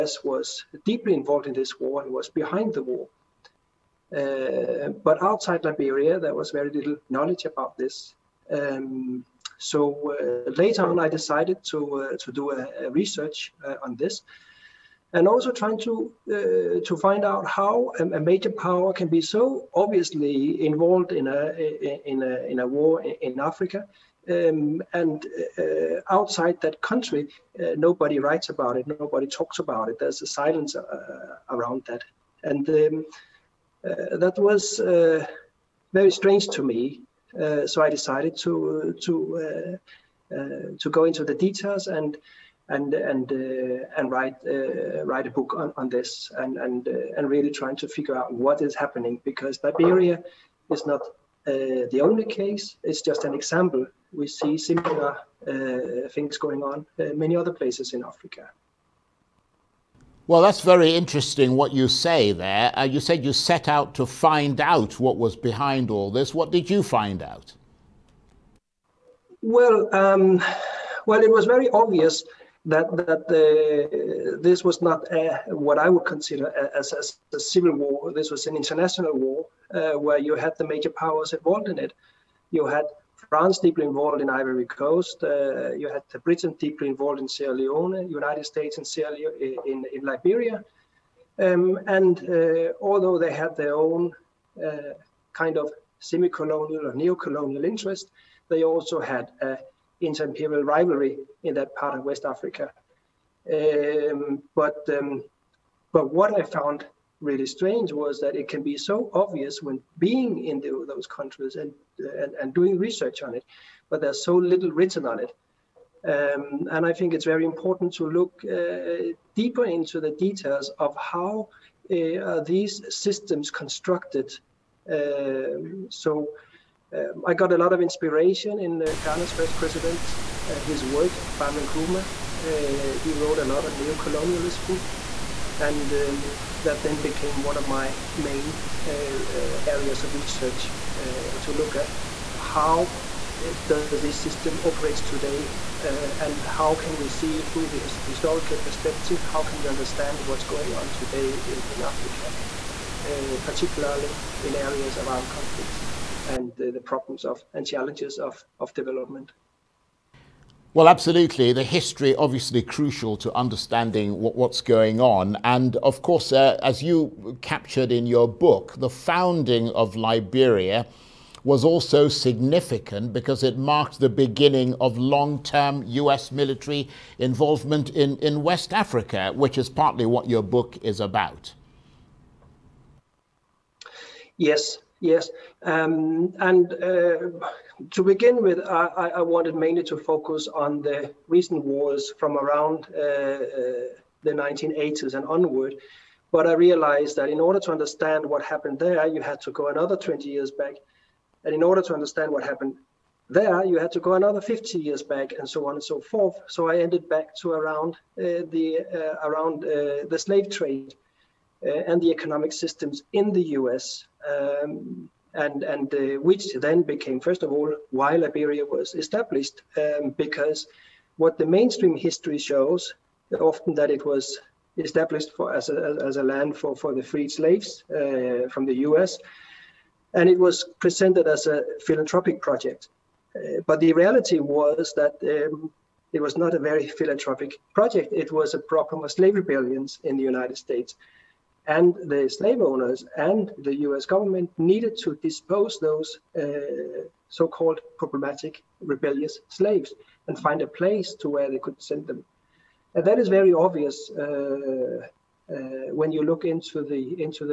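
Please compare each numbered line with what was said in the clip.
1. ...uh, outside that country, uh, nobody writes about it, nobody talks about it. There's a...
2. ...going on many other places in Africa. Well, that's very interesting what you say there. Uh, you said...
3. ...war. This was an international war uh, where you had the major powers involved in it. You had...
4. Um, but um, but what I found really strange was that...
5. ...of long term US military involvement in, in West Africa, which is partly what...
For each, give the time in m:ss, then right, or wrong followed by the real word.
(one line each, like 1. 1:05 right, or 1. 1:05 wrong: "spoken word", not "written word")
1. 0:25 right
2. 0:56 right
3. 1:17 right
4. 1:43 right
5. 2:54 right.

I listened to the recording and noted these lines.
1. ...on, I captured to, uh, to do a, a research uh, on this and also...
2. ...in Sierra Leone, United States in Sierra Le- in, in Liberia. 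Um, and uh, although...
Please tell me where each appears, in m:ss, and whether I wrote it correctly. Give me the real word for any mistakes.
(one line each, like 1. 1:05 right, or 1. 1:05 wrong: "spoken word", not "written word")
1. 0:10 wrong: "decided", not "captured"
2. 1:27 right.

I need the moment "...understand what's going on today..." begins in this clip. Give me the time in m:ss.
2:29.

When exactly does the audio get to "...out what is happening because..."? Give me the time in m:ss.
0:48.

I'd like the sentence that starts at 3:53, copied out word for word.
Uh, but the reality was that um, it was not a very philanthropic project.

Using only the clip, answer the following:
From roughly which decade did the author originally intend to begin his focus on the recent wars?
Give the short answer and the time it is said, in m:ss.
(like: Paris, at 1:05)
1980s, at 3:14.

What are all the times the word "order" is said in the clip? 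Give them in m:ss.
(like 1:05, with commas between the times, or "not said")
3:17, 3:21.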